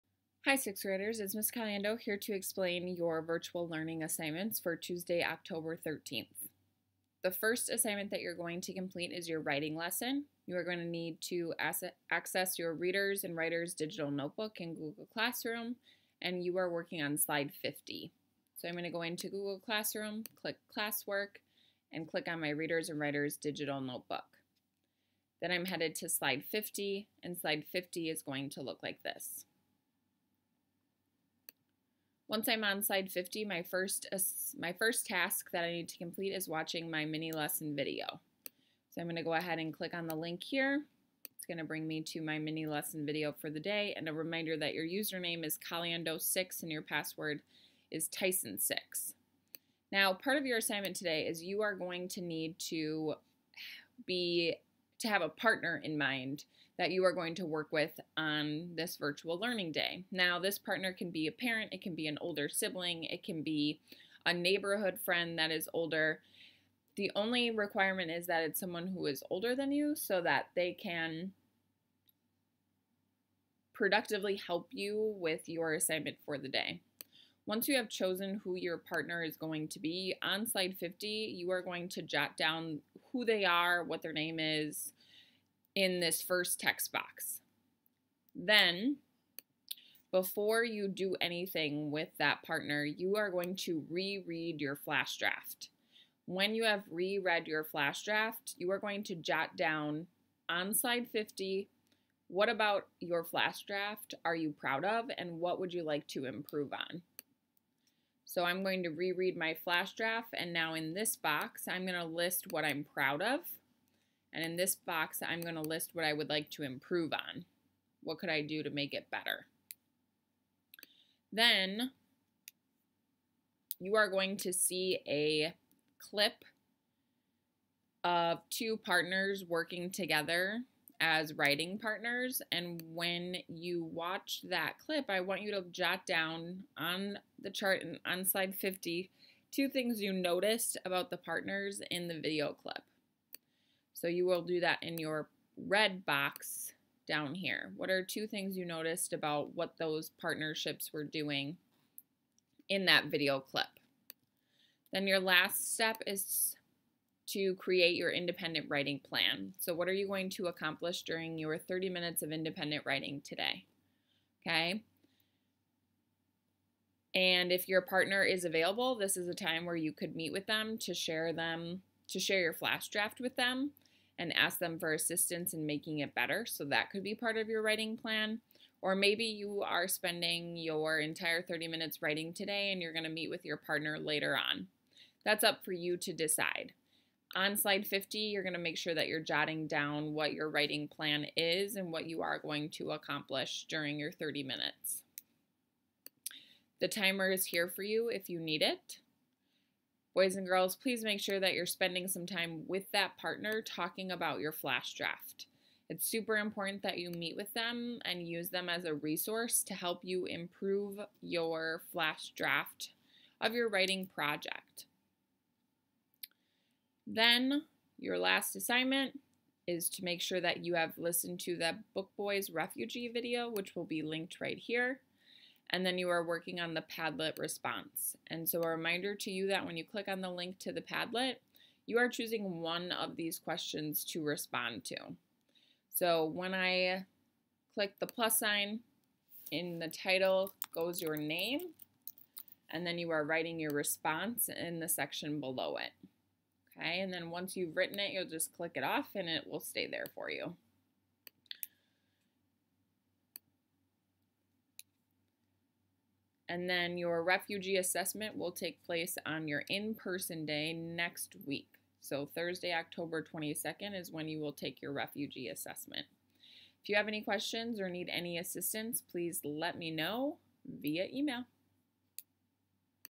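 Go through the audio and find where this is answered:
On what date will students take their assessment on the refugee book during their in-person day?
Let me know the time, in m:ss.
4:22.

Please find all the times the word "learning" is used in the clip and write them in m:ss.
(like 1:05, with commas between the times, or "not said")
0:03, 0:59.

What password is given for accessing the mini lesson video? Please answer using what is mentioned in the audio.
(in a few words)
Tyson6.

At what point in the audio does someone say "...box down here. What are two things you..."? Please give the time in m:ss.
2:26.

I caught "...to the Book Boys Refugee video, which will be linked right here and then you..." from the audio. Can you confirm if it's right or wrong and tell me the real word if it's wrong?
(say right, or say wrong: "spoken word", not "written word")
right.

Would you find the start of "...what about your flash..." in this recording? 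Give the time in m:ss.
1:42.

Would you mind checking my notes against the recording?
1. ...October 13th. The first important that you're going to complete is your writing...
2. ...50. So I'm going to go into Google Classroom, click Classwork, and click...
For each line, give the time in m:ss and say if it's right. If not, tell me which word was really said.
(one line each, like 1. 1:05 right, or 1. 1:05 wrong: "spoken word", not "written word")
1. 0:05 wrong: "assignment", not "important"
2. 0:17 right.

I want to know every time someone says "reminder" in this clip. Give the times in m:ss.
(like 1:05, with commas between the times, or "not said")
0:44, 3:48.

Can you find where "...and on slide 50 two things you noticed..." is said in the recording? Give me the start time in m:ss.
2:17.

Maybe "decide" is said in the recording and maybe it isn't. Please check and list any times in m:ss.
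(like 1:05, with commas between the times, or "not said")
3:06.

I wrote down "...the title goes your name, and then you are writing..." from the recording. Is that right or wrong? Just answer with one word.
right.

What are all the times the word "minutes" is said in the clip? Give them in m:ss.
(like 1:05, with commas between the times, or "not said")
2:41, 3:01, 3:14.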